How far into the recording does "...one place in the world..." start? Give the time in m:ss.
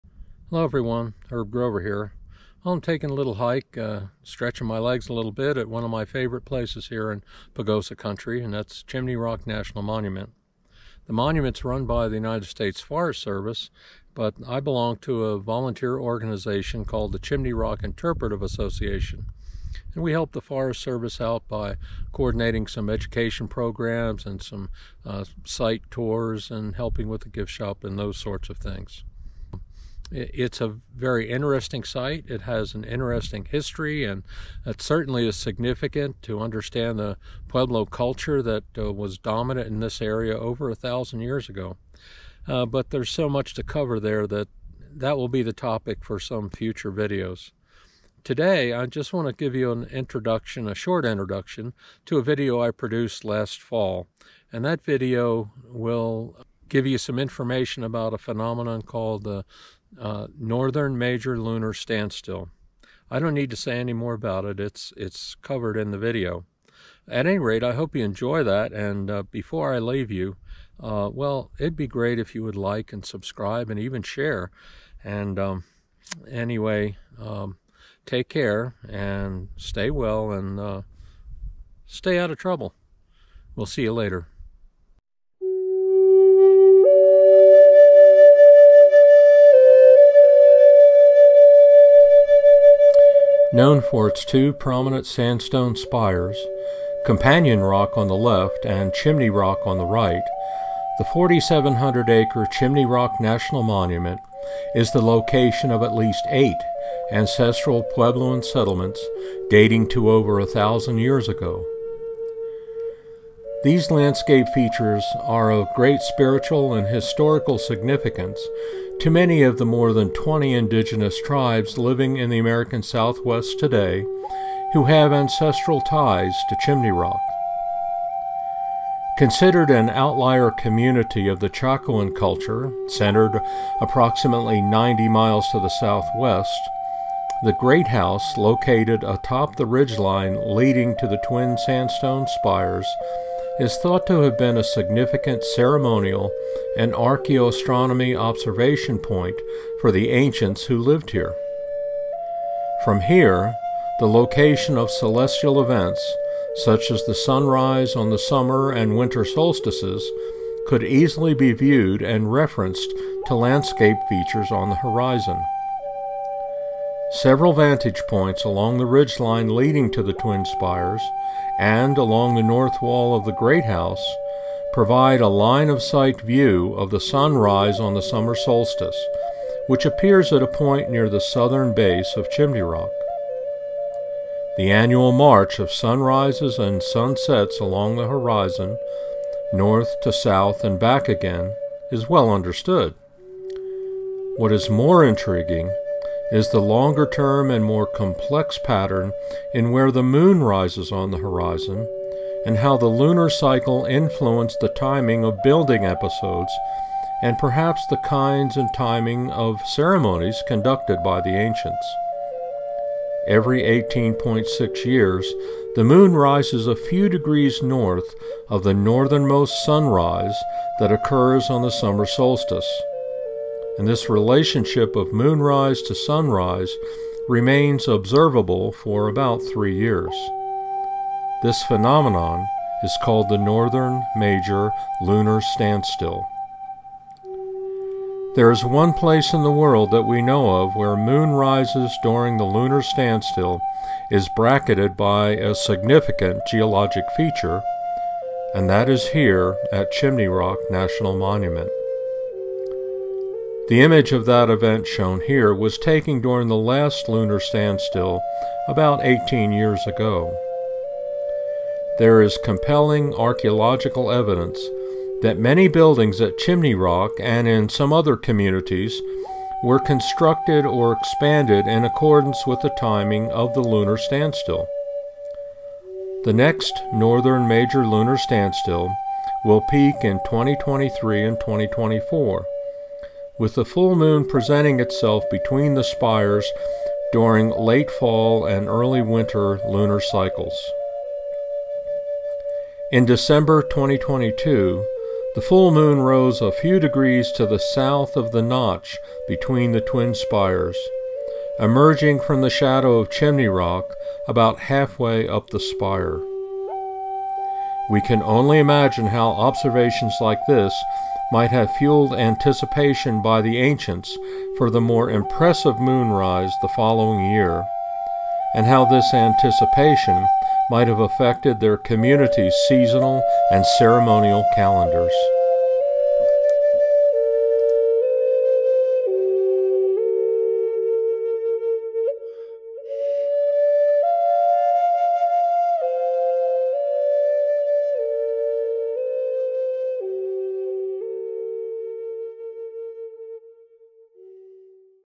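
3:58.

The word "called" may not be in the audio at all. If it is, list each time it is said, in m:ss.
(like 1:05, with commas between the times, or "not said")
0:16, 0:58, 3:53.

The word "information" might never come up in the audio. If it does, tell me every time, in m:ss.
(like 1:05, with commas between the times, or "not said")
0:57.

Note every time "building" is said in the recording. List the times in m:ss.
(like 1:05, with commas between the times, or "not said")
3:25, 4:25.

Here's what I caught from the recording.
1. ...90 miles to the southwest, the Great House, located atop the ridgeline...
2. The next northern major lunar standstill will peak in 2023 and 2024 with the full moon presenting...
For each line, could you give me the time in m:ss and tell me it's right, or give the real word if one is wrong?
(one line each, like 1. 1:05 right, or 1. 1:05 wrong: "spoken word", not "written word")
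1. 2:14 right
2. 4:36 right.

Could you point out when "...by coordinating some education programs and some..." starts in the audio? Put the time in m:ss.
0:21.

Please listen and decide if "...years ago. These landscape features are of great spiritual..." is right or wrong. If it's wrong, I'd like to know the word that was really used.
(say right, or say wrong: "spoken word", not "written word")
right.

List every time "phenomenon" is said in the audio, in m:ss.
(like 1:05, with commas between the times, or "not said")
0:58, 3:51.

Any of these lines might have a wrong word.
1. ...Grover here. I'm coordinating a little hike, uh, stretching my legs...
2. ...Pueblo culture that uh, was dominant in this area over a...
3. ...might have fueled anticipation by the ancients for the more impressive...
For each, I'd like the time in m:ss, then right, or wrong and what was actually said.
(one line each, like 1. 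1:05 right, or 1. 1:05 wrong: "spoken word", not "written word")
1. 0:01 wrong: "taking", not "coordinating"
2. 0:37 right
3. 5:11 right.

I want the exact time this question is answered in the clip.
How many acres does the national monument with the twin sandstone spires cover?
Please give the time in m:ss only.
1:41.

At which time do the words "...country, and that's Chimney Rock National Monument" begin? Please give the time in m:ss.
0:07.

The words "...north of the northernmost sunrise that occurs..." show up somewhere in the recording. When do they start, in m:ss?
3:37.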